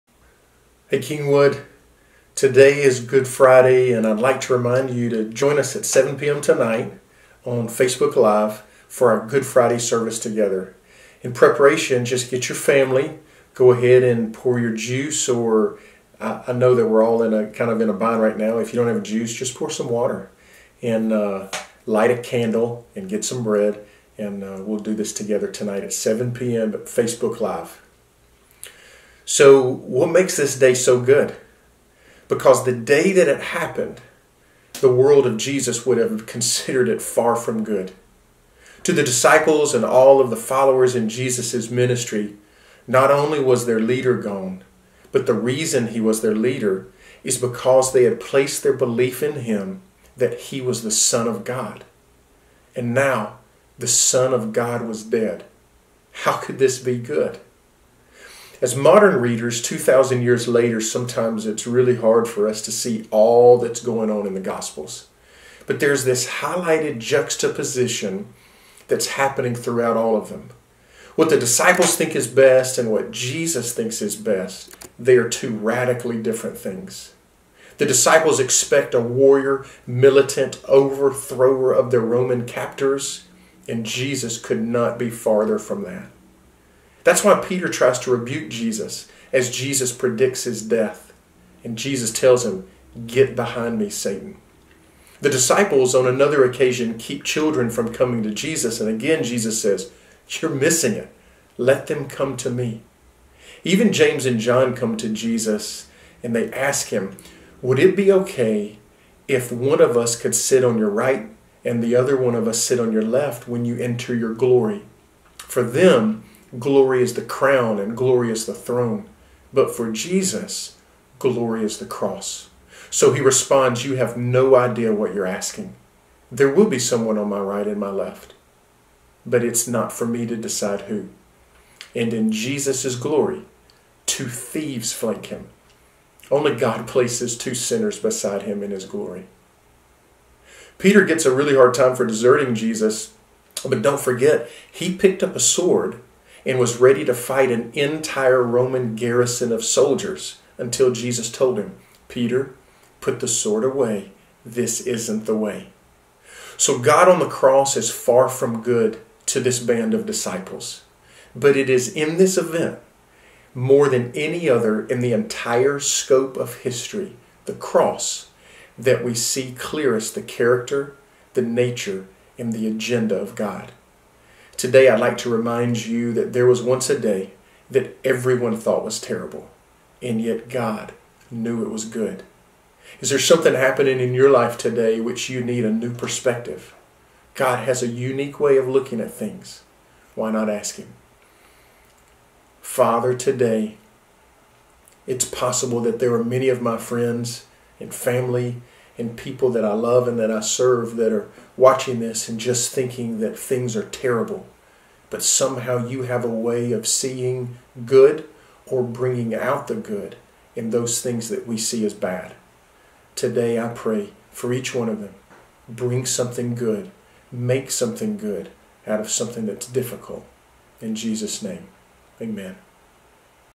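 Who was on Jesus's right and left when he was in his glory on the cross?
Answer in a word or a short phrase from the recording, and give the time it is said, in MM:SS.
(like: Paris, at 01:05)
Two thieves, at 02:14.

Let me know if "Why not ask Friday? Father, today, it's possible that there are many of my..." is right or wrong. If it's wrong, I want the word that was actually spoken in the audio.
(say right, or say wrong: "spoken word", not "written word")
wrong: "Him", not "Friday".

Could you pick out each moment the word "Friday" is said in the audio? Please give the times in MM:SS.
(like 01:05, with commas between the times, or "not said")
00:03, 00:09.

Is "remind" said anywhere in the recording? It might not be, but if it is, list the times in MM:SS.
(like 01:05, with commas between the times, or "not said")
00:04, 02:55.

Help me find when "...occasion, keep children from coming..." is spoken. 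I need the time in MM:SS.
01:36.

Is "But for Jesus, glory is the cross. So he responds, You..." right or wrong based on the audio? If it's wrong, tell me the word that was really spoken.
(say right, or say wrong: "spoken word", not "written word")
right.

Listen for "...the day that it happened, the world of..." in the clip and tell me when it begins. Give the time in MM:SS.
00:32.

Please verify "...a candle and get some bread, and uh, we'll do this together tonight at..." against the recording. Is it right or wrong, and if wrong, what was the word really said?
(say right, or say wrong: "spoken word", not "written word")
right.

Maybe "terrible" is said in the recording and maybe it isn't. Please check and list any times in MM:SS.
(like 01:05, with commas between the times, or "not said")
02:59, 03:23.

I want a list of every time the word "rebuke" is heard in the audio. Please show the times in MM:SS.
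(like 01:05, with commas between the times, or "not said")
01:28.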